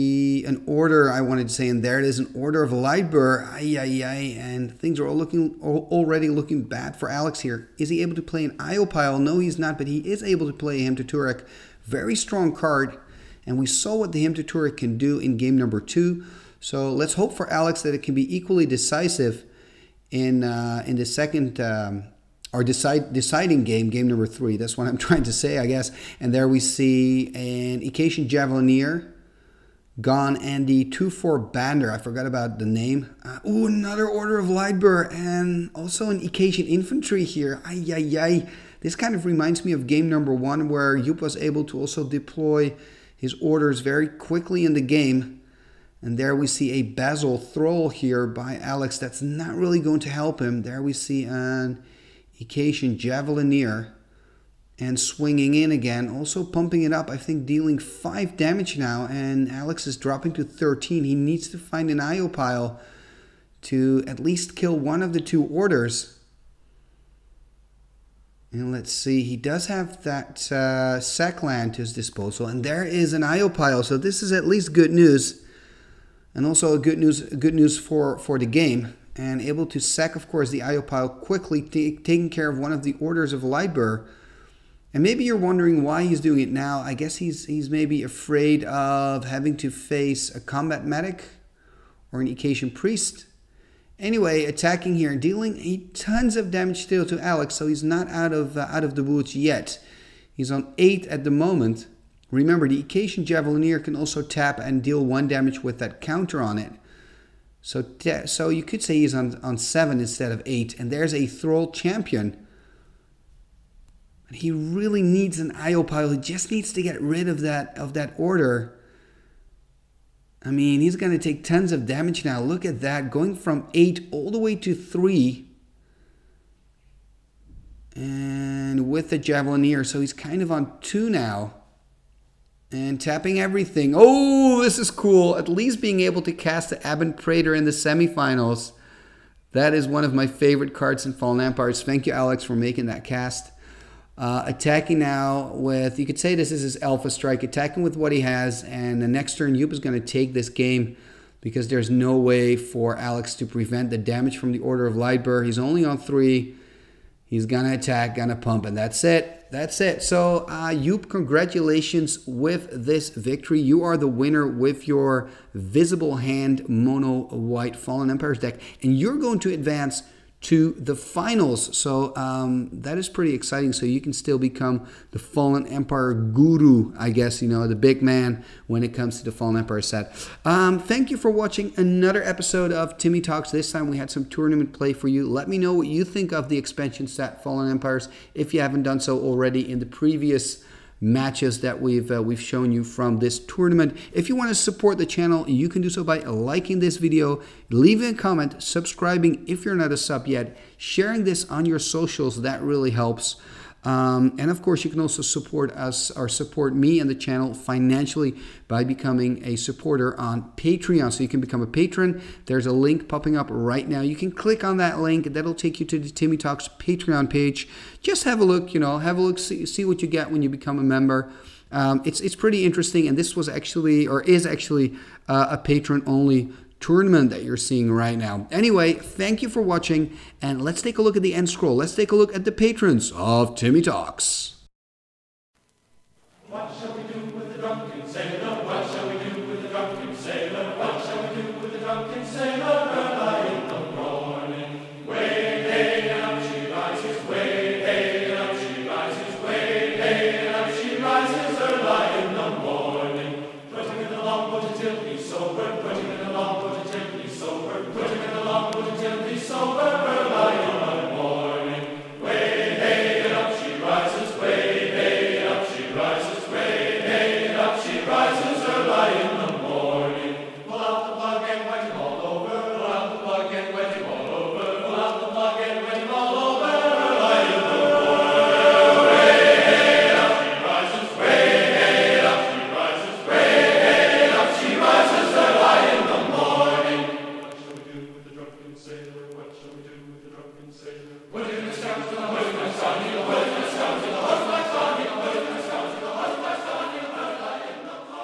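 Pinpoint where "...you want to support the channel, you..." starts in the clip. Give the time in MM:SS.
03:14.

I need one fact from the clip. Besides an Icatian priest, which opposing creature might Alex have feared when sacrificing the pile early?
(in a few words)
Combat medic.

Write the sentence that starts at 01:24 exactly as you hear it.
And maybe you're wondering why he's doing it now.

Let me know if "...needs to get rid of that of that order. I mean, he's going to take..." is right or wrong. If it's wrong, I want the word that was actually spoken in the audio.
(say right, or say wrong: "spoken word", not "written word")
right.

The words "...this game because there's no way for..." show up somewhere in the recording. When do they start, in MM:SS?
02:30.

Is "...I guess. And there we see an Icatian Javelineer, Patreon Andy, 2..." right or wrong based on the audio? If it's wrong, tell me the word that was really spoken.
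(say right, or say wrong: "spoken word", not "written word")
wrong: "Gone", not "Patreon".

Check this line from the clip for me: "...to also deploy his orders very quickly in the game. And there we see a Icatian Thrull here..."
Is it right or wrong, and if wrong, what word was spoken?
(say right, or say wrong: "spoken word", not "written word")
wrong: "Basal", not "Icatian".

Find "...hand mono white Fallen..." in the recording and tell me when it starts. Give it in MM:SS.
02:46.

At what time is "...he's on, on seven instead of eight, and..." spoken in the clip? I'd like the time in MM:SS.
01:48.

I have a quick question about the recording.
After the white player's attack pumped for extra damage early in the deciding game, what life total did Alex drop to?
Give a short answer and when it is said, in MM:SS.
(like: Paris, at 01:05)
13, at 00:59.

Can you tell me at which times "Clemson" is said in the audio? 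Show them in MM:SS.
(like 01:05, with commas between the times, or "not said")
not said.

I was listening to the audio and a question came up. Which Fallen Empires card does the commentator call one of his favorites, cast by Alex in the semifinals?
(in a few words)
Ebon Praetor.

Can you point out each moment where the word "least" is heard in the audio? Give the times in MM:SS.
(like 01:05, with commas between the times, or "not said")
01:04, 01:14, 02:15.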